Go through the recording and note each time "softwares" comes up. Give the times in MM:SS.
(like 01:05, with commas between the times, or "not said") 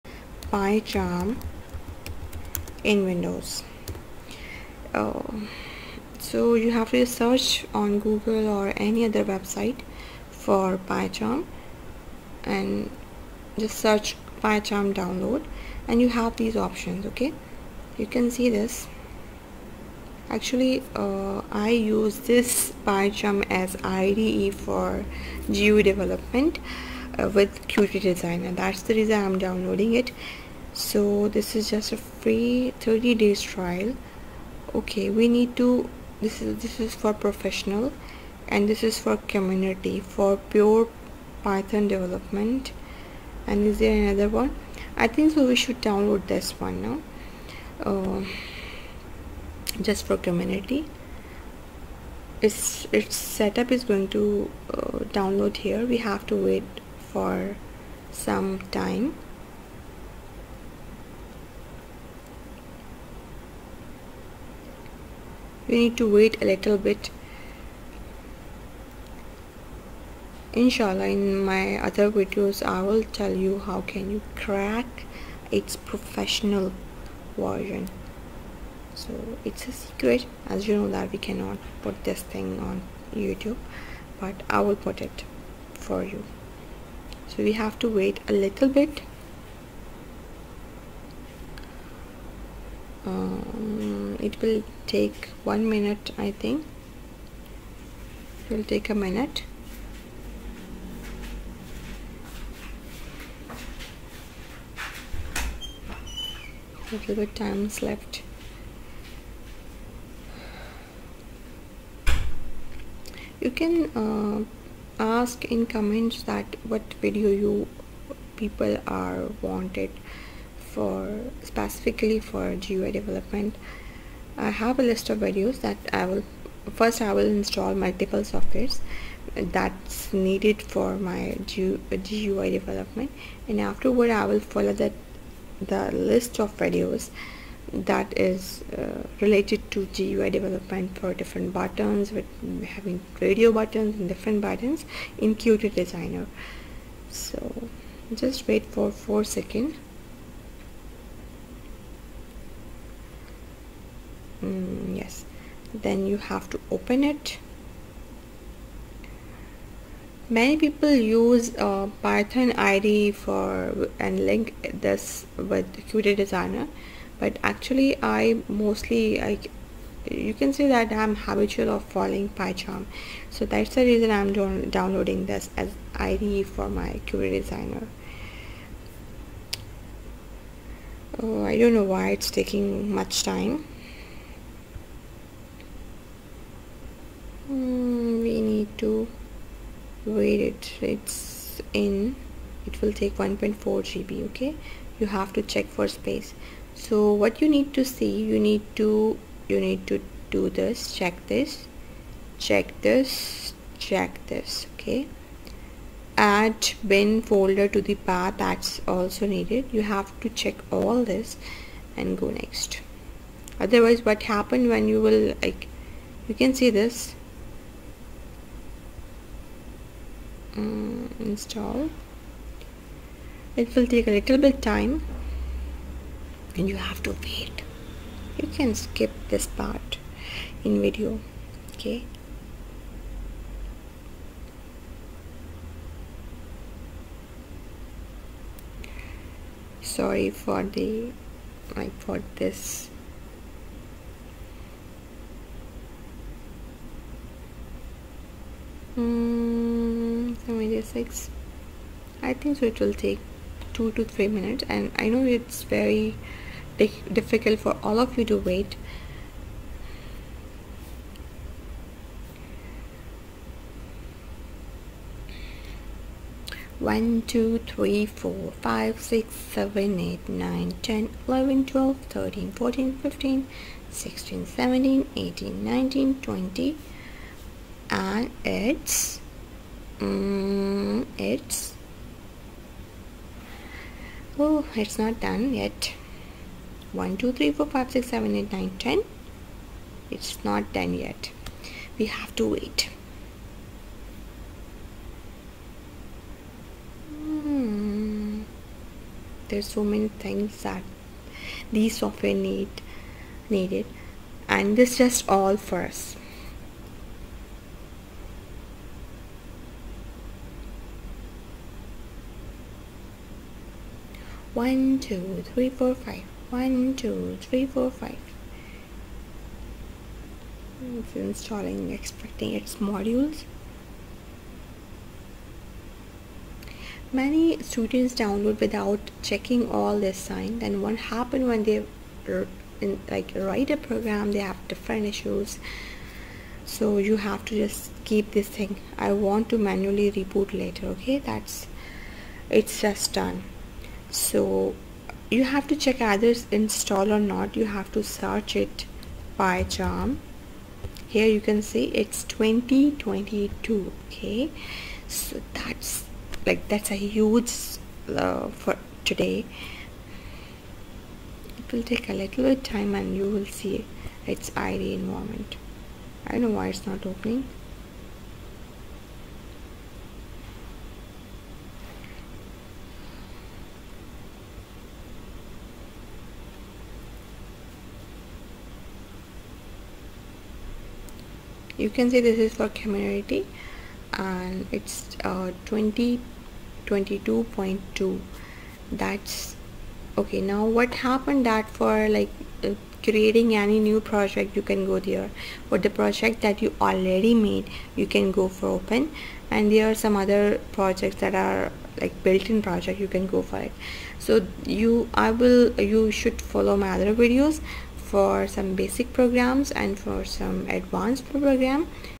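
02:08, 05:02.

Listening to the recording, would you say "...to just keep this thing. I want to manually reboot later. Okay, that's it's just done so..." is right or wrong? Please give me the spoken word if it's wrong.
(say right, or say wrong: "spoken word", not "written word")
right.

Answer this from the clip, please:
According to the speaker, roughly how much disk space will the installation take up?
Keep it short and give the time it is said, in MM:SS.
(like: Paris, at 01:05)
1.4 GB, at 03:13.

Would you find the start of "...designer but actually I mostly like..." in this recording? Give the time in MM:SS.
02:46.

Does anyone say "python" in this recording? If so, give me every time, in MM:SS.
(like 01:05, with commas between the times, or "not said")
00:41, 02:42.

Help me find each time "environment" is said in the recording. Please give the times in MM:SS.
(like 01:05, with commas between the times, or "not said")
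06:04.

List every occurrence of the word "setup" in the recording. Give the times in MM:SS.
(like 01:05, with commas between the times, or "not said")
00:53.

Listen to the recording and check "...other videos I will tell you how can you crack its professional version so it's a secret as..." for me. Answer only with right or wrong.
right.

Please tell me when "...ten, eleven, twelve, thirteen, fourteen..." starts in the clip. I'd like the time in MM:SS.
04:30.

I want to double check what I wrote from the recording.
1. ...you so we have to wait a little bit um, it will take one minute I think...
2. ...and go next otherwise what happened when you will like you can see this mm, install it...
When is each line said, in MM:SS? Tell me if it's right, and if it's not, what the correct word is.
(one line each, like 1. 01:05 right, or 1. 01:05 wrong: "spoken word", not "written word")
1. 01:26 right
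2. 03:31 right.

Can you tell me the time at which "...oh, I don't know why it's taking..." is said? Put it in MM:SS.
03:01.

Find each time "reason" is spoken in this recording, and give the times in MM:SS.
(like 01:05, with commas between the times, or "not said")
00:28, 02:53.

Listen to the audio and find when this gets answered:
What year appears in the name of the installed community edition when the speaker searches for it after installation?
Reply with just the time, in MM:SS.
05:52.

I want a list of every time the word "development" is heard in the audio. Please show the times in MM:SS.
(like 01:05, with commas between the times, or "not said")
00:25, 00:41, 02:02, 02:12, 02:20.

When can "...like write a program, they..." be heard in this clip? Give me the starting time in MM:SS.
05:33.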